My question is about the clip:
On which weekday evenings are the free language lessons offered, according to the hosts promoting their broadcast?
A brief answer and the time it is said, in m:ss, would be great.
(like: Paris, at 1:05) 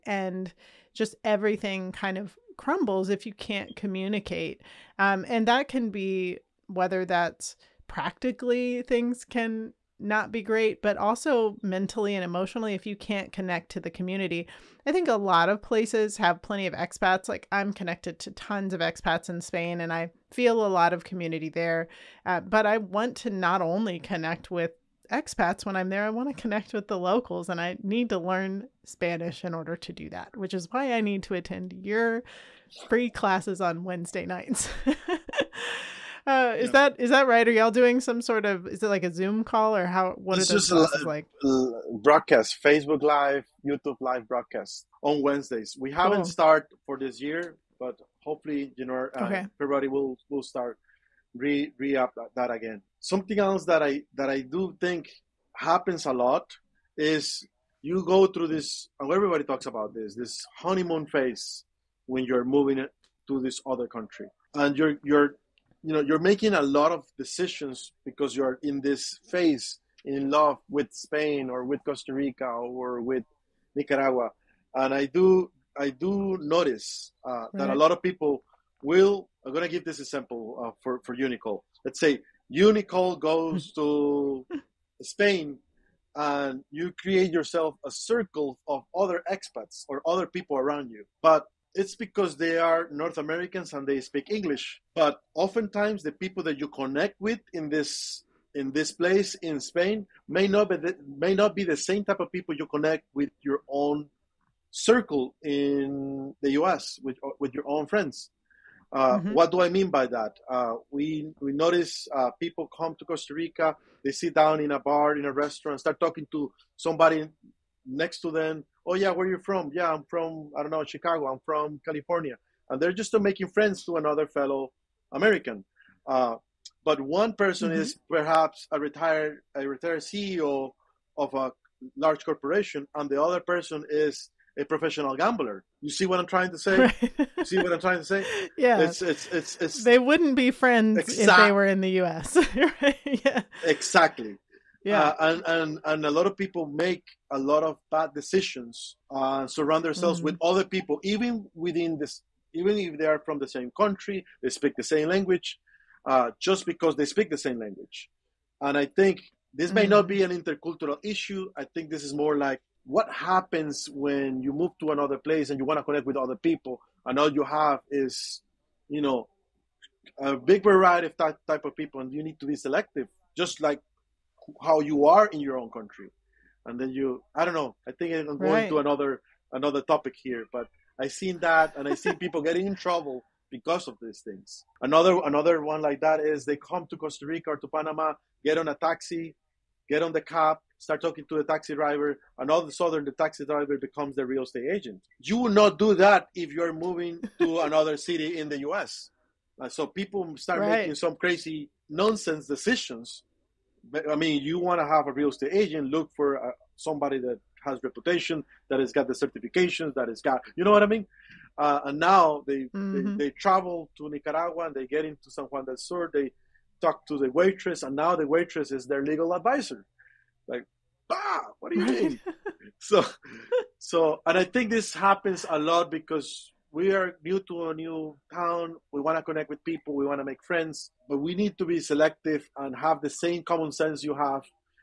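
Wednesday, at 0:33.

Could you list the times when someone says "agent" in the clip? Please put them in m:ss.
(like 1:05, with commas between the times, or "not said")
3:14, 3:25.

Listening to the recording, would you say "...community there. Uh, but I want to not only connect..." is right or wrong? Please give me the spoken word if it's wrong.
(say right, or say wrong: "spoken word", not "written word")
right.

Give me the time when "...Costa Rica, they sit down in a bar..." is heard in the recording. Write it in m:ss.
1:53.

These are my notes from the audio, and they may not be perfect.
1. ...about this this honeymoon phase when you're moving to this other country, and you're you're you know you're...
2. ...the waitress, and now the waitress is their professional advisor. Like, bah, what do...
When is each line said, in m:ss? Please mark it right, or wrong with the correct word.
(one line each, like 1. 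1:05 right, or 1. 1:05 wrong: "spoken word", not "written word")
1. 0:59 right
2. 3:37 wrong: "legal", not "professional".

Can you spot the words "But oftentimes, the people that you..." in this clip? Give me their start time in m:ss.
1:34.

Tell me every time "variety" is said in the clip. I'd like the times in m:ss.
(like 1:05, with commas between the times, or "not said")
2:50.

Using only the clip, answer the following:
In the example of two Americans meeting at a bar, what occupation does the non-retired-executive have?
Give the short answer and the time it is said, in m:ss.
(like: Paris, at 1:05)
professional gambler, at 2:14.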